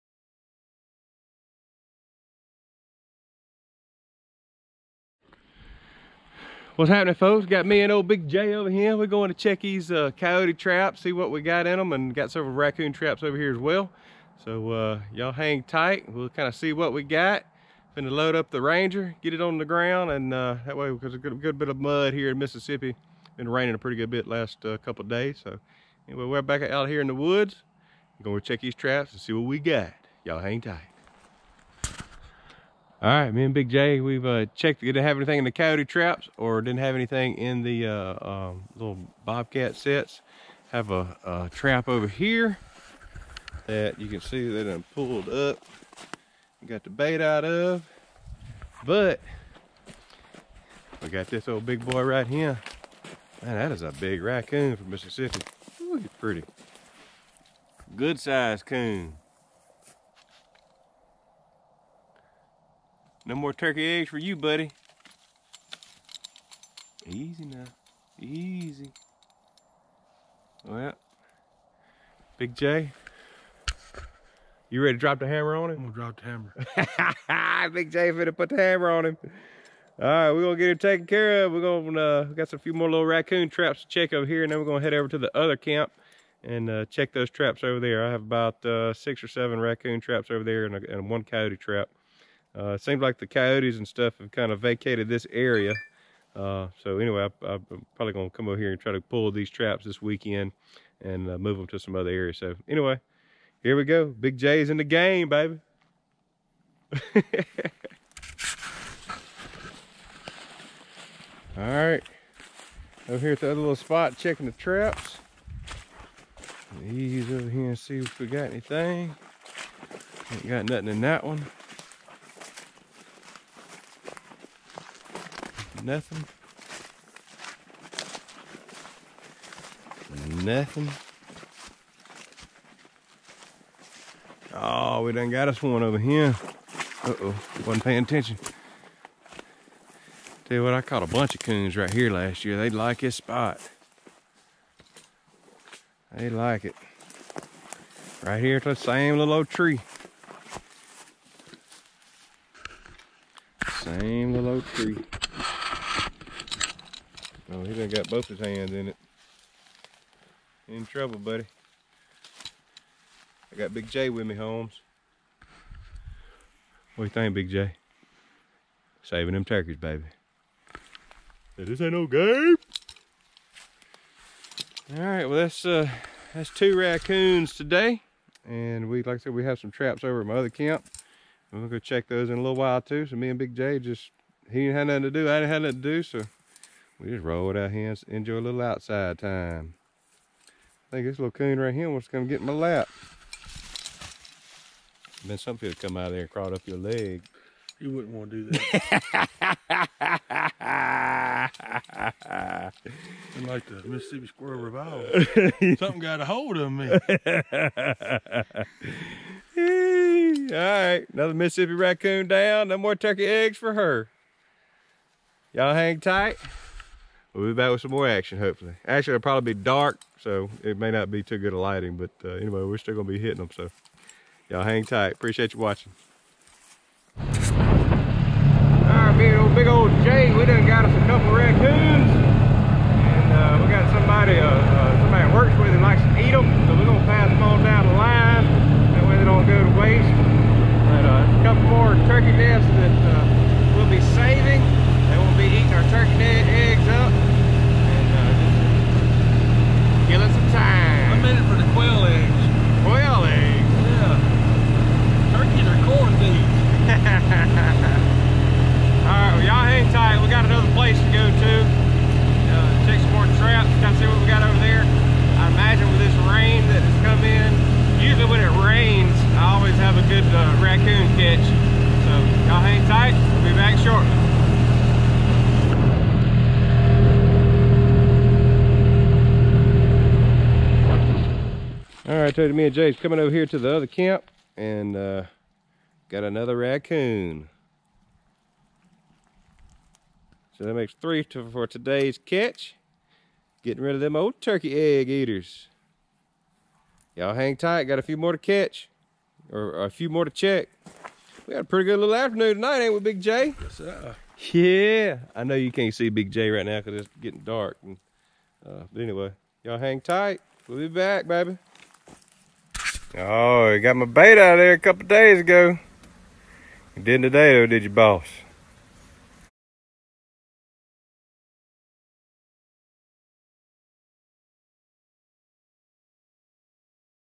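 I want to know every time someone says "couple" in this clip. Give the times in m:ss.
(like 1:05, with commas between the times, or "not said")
0:24, 3:51, 5:14.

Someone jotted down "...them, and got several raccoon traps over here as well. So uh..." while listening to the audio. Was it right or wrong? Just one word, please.
right.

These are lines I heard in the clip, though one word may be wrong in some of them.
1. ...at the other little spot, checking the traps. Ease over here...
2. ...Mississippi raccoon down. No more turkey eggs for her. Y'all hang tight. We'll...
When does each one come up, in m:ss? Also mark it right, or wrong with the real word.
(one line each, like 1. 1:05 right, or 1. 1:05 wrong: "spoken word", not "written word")
1. 1:53 right
2. 3:31 right.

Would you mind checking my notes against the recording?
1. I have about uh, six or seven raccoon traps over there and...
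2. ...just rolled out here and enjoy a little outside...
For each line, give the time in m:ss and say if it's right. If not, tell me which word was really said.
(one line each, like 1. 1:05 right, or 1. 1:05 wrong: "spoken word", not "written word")
1. 1:28 right
2. 3:07 right.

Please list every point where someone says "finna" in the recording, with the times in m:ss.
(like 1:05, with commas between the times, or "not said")
0:17, 1:18.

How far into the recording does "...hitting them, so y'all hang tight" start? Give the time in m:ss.
3:43.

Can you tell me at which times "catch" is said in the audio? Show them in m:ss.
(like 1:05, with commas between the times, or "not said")
4:52, 4:58.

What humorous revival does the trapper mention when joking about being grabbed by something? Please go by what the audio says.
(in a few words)
Mississippi Squirrel Revival.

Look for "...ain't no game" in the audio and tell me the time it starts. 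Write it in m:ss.
2:51.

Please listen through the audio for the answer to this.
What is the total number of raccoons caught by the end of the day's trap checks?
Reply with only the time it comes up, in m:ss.
4:51.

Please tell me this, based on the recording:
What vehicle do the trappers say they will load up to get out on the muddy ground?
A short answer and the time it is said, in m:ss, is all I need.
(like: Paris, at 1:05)
Ranger, at 0:18.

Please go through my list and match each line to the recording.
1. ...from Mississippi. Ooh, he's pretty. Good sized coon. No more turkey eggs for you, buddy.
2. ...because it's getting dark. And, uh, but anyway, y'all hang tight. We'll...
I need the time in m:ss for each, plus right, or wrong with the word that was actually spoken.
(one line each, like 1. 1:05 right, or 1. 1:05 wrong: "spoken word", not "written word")
1. 0:54 right
2. 5:06 right.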